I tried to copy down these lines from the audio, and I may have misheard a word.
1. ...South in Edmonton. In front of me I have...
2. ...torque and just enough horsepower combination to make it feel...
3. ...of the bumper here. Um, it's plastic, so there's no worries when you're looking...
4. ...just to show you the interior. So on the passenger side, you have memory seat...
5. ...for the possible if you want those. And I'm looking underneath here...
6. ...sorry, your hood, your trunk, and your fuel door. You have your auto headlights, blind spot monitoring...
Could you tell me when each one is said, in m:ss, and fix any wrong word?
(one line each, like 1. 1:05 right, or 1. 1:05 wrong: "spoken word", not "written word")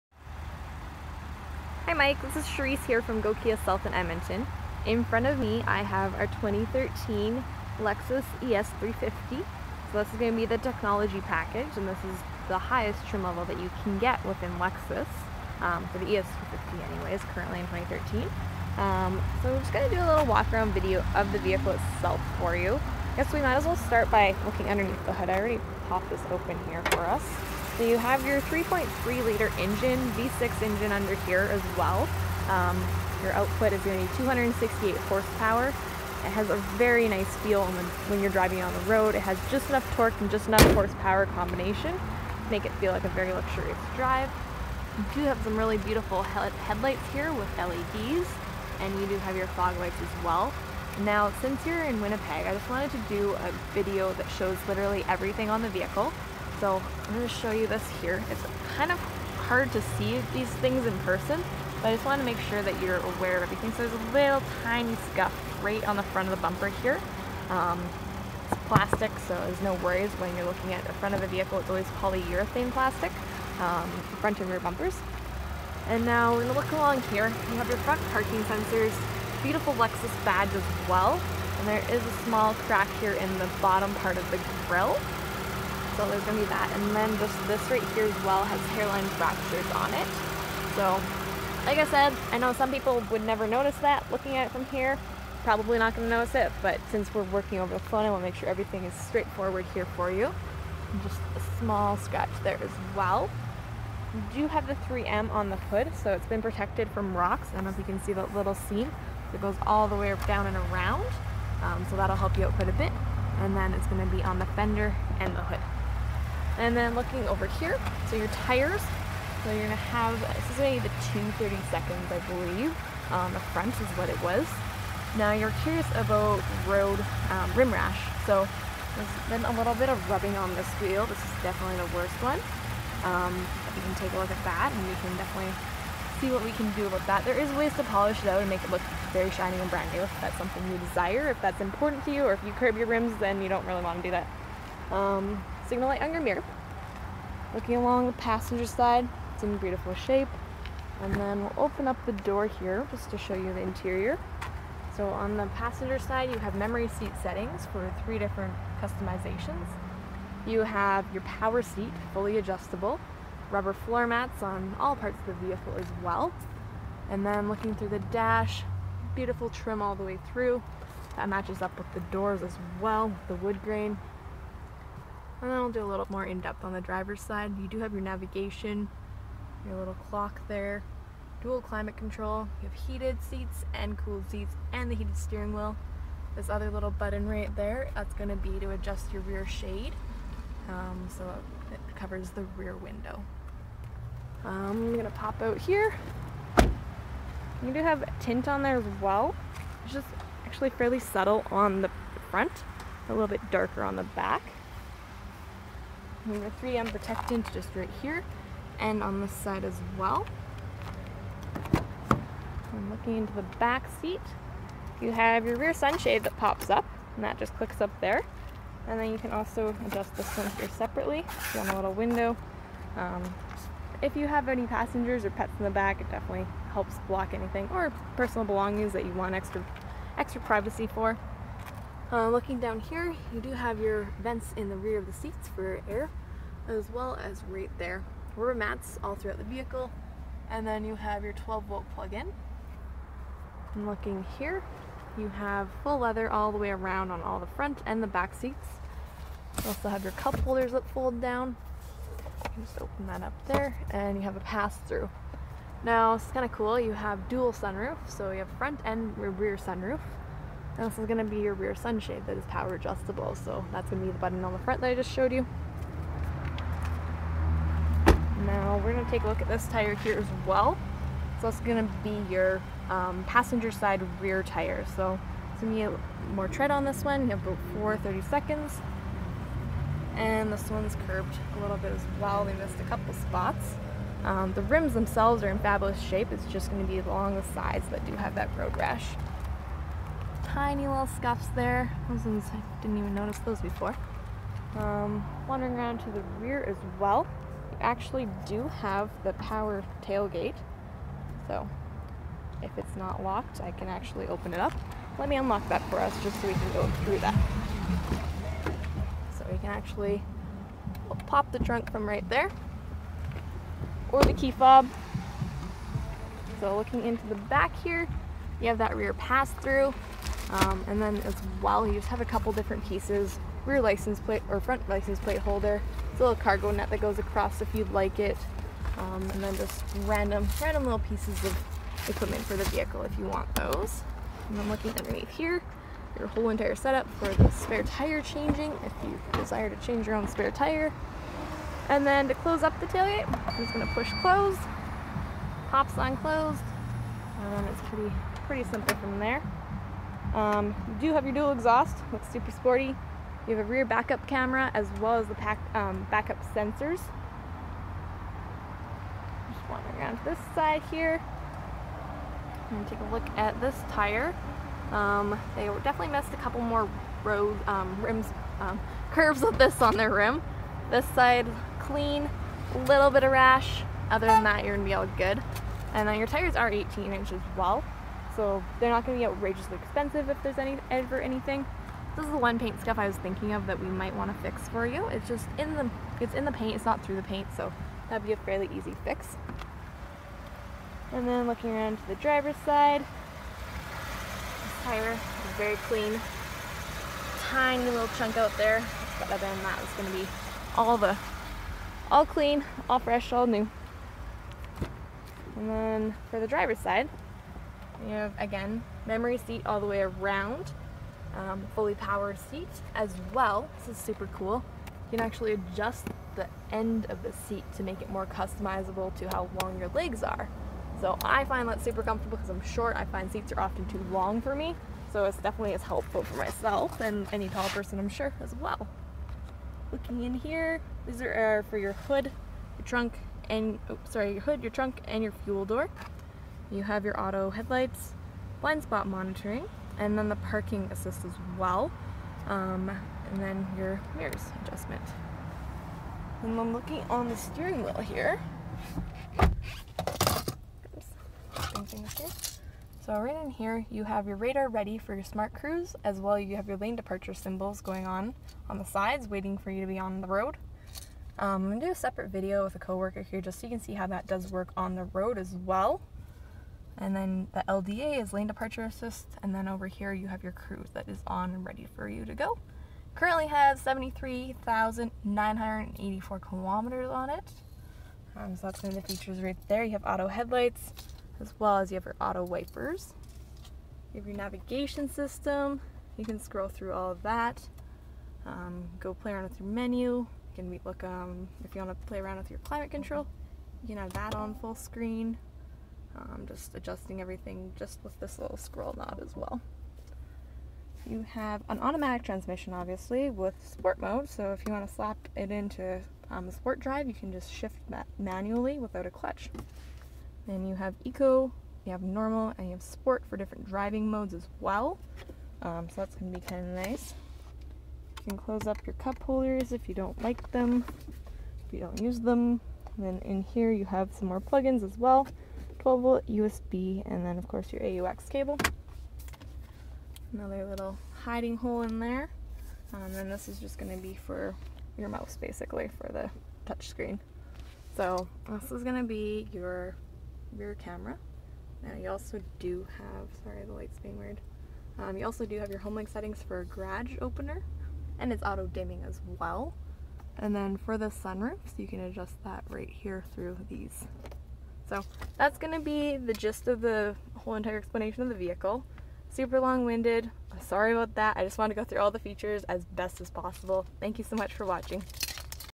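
1. 0:03 right
2. 0:39 right
3. 1:06 right
4. 2:32 right
5. 5:32 wrong: "vehicle", not "possible"
6. 7:14 right.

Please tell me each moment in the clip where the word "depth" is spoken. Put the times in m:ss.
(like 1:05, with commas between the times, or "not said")
2:56.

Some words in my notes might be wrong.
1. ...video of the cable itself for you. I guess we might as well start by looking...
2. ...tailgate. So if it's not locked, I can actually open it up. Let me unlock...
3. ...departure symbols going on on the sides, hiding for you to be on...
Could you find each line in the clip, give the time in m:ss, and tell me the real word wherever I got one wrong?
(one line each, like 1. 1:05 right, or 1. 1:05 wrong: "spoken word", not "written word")
1. 0:20 wrong: "vehicle", not "cable"
2. 5:00 right
3. 7:36 wrong: "waiting", not "hiding".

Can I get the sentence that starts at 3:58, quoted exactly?
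Rubber mats all throughout the vehicle, and then you have your 12 volt plug-in.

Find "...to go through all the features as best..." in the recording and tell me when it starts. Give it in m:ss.
9:21.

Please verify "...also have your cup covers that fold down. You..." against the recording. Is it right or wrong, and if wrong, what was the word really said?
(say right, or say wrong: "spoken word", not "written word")
wrong: "holders", not "covers".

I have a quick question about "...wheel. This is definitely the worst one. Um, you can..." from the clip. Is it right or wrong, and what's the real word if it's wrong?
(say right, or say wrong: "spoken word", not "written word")
right.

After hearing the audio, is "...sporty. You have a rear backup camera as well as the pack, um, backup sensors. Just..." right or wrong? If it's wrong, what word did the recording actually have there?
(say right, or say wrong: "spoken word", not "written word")
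right.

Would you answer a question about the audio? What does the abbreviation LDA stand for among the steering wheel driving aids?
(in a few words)
Lane departure assist.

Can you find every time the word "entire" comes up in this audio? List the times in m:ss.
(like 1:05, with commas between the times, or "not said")
5:36, 9:17.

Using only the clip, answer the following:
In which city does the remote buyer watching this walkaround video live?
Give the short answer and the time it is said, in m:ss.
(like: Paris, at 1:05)
Winnipeg, at 0:52.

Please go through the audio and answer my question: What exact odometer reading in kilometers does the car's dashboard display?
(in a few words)
73,984 kilometers.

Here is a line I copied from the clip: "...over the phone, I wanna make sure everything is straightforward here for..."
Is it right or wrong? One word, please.
right.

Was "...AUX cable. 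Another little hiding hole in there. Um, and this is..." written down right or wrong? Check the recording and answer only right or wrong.
right.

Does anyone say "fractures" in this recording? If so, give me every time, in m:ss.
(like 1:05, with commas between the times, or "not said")
1:29.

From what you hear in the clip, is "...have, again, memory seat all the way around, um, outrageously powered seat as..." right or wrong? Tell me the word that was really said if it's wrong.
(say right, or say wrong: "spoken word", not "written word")
wrong: "fully", not "outrageously".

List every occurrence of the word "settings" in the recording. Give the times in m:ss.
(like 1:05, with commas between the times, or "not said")
2:37, 9:06.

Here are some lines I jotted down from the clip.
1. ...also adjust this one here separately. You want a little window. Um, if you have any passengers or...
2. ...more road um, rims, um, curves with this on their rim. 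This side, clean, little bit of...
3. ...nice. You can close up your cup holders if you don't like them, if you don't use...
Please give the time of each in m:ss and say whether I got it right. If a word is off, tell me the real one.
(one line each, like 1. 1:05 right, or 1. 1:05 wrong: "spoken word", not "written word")
1. 3:39 right
2. 6:06 right
3. 8:36 right.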